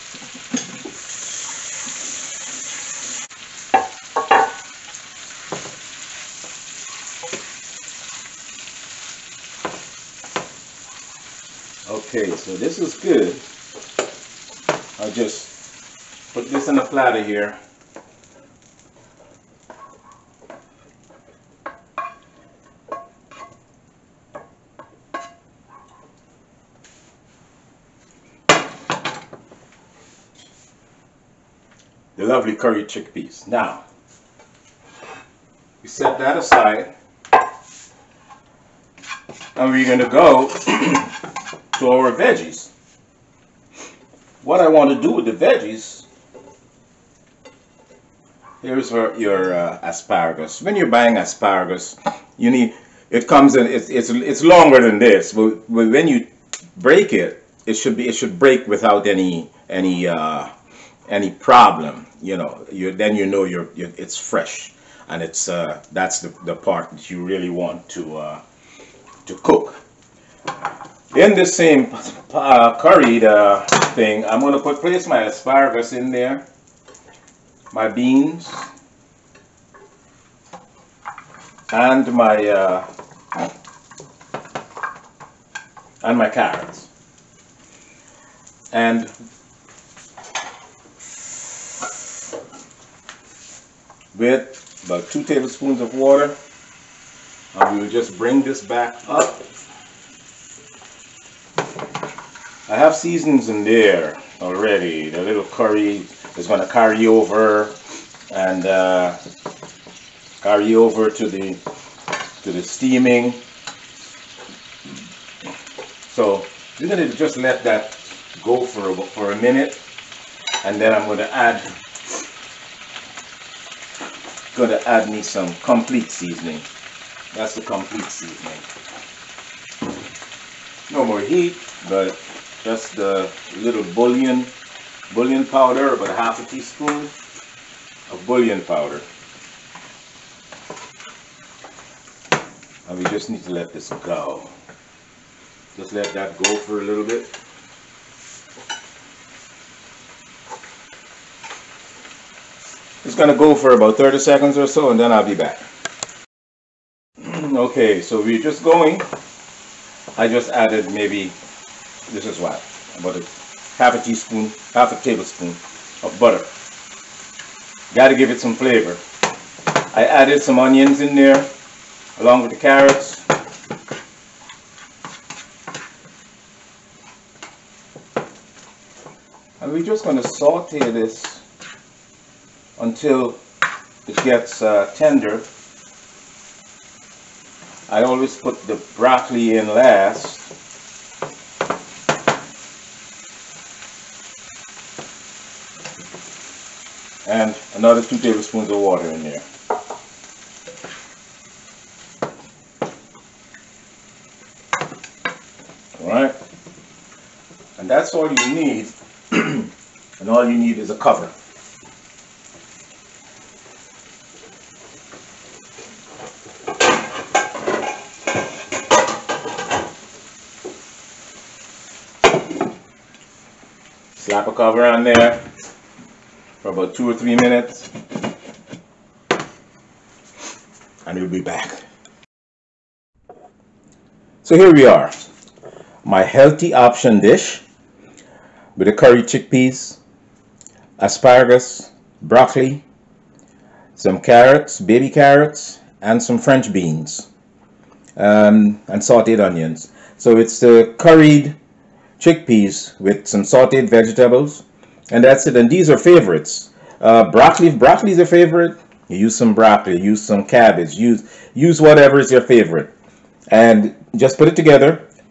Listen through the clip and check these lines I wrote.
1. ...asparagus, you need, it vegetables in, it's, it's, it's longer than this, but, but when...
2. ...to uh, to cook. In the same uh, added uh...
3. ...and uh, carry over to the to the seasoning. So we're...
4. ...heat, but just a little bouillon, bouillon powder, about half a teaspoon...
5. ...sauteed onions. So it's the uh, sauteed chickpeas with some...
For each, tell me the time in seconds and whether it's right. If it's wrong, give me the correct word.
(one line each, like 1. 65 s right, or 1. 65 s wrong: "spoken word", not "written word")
1. 51 s wrong: "comes", not "vegetables"
2. 67 s wrong: "curried", not "added"
3. 108 s wrong: "steaming", not "seasoning"
4. 131 s right
5. 248 s wrong: "curried", not "sauteed".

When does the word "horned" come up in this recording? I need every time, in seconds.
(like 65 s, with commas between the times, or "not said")
not said.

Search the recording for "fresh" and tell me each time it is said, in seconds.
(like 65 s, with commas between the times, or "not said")
64 s.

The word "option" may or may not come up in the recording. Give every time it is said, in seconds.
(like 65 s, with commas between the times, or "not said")
236 s.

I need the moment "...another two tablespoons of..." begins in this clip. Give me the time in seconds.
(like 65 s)
197 s.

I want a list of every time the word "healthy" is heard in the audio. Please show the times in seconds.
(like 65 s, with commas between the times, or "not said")
236 s.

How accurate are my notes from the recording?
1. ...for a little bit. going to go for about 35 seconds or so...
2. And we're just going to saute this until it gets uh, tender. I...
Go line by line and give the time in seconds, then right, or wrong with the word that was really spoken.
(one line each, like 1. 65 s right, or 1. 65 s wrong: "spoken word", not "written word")
1. 146 s wrong: "30", not "35"
2. 179 s right.